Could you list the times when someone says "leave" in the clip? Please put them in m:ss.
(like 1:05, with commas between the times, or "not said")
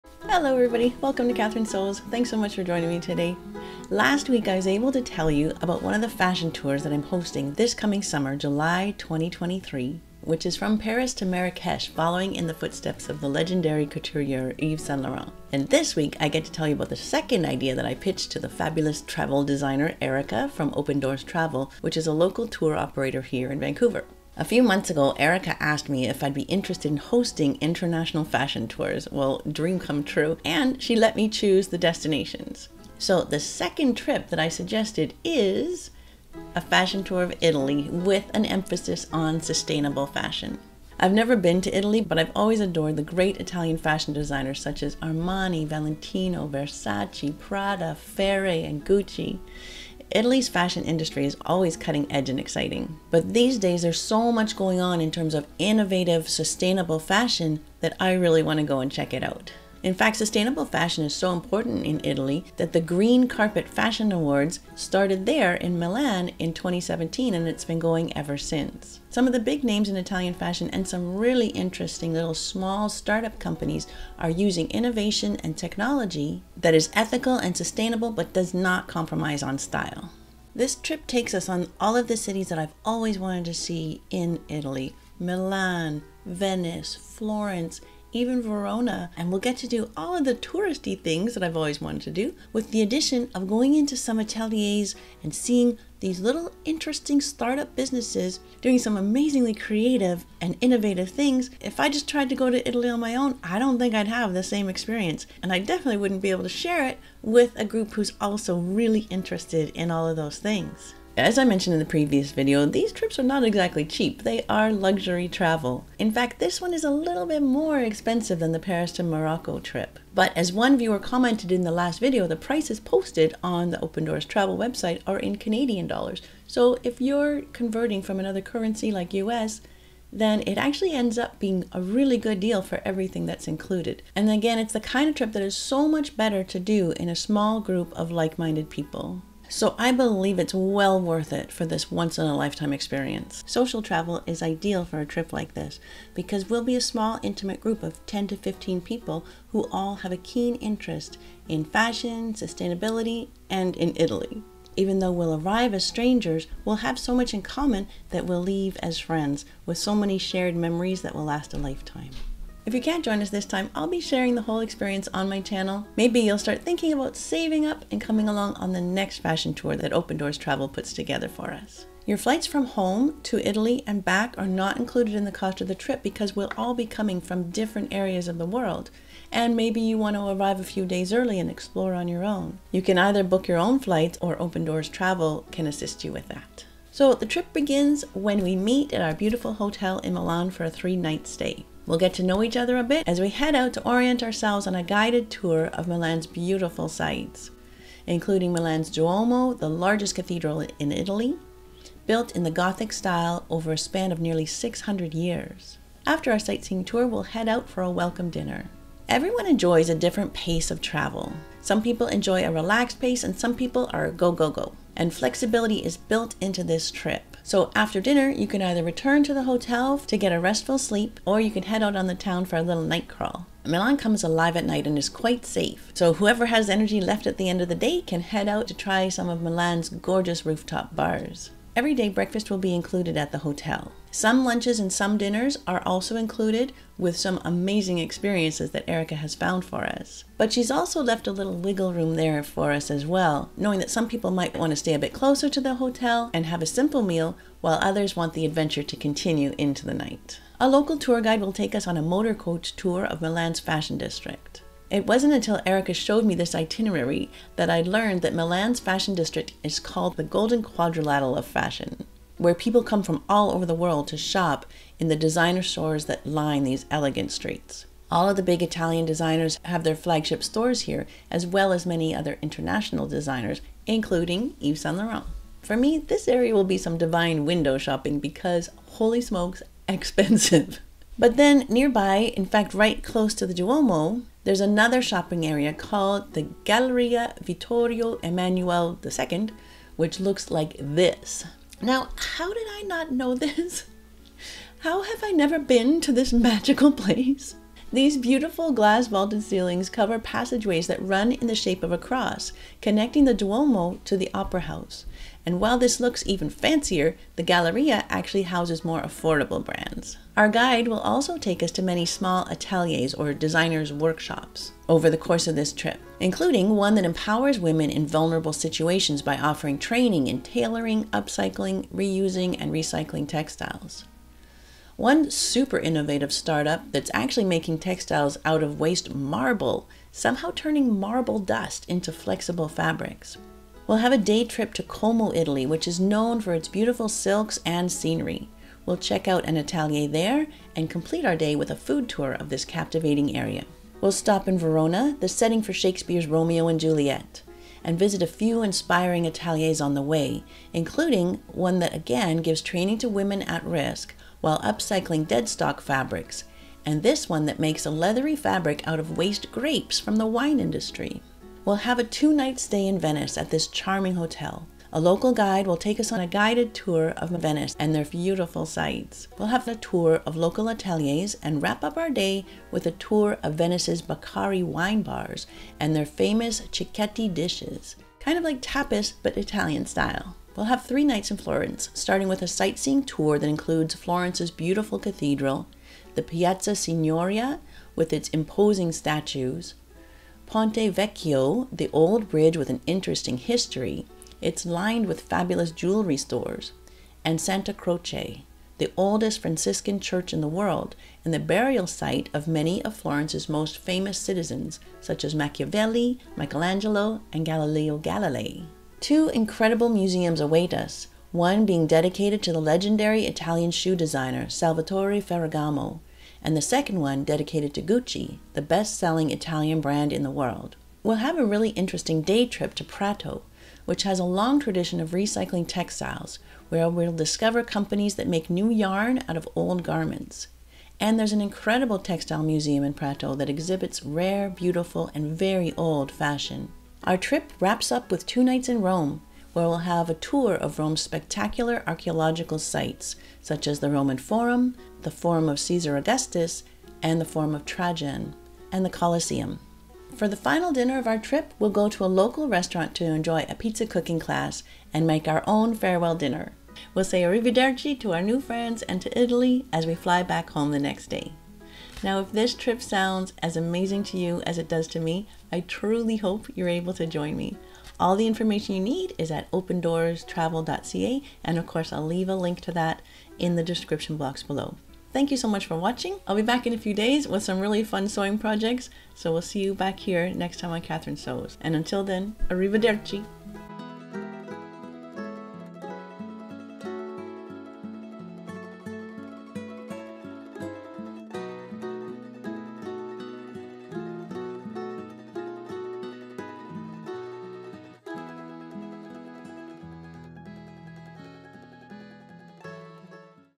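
2:38, 7:52.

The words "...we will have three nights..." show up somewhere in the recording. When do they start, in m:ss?
6:20.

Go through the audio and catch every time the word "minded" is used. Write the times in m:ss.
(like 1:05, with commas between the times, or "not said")
2:18.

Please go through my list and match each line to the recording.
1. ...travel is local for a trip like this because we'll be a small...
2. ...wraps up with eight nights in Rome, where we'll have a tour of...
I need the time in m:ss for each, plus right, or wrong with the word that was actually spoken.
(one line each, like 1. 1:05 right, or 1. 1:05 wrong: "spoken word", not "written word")
1. 2:23 wrong: "ideal", not "local"
2. 7:17 wrong: "two", not "eight".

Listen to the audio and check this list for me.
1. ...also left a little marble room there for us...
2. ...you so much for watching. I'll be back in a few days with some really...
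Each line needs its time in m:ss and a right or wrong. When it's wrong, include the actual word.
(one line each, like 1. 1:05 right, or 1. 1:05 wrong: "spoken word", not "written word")
1. 4:00 wrong: "wiggle", not "marble"
2. 7:55 right.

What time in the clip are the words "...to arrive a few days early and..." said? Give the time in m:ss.
3:00.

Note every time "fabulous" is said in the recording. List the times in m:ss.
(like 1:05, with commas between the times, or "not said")
0:18, 6:35.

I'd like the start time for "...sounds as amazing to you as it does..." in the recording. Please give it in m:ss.
7:42.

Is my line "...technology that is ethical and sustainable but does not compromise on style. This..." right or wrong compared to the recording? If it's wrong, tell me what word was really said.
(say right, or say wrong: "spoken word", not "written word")
right.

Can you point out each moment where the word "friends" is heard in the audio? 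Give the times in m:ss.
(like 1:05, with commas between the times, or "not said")
2:38, 7:38.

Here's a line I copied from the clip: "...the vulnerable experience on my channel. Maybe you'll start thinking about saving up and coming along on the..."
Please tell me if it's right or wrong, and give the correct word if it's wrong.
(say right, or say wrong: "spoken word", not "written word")
wrong: "whole", not "vulnerable".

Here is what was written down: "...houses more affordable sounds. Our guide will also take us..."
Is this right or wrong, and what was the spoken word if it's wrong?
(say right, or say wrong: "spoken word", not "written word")
wrong: "brands", not "sounds".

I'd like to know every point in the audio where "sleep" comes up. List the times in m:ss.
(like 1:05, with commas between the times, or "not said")
3:40.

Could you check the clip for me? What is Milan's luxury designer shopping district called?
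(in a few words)
Golden Quadrilateral of Fashion.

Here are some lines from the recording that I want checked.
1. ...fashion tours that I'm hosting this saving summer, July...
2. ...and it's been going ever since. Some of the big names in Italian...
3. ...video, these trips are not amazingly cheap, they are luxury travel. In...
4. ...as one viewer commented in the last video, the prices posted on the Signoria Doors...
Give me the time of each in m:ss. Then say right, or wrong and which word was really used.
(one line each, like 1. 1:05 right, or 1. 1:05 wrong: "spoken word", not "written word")
1. 0:06 wrong: "coming", not "saving"
2. 1:07 right
3. 1:52 wrong: "exactly", not "amazingly"
4. 2:00 wrong: "Open", not "Signoria".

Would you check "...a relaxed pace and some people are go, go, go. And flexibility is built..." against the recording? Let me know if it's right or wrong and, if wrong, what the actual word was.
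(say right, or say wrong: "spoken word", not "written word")
right.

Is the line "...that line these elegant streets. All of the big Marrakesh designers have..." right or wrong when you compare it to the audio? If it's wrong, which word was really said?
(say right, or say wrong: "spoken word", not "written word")
wrong: "Italian", not "Marrakesh".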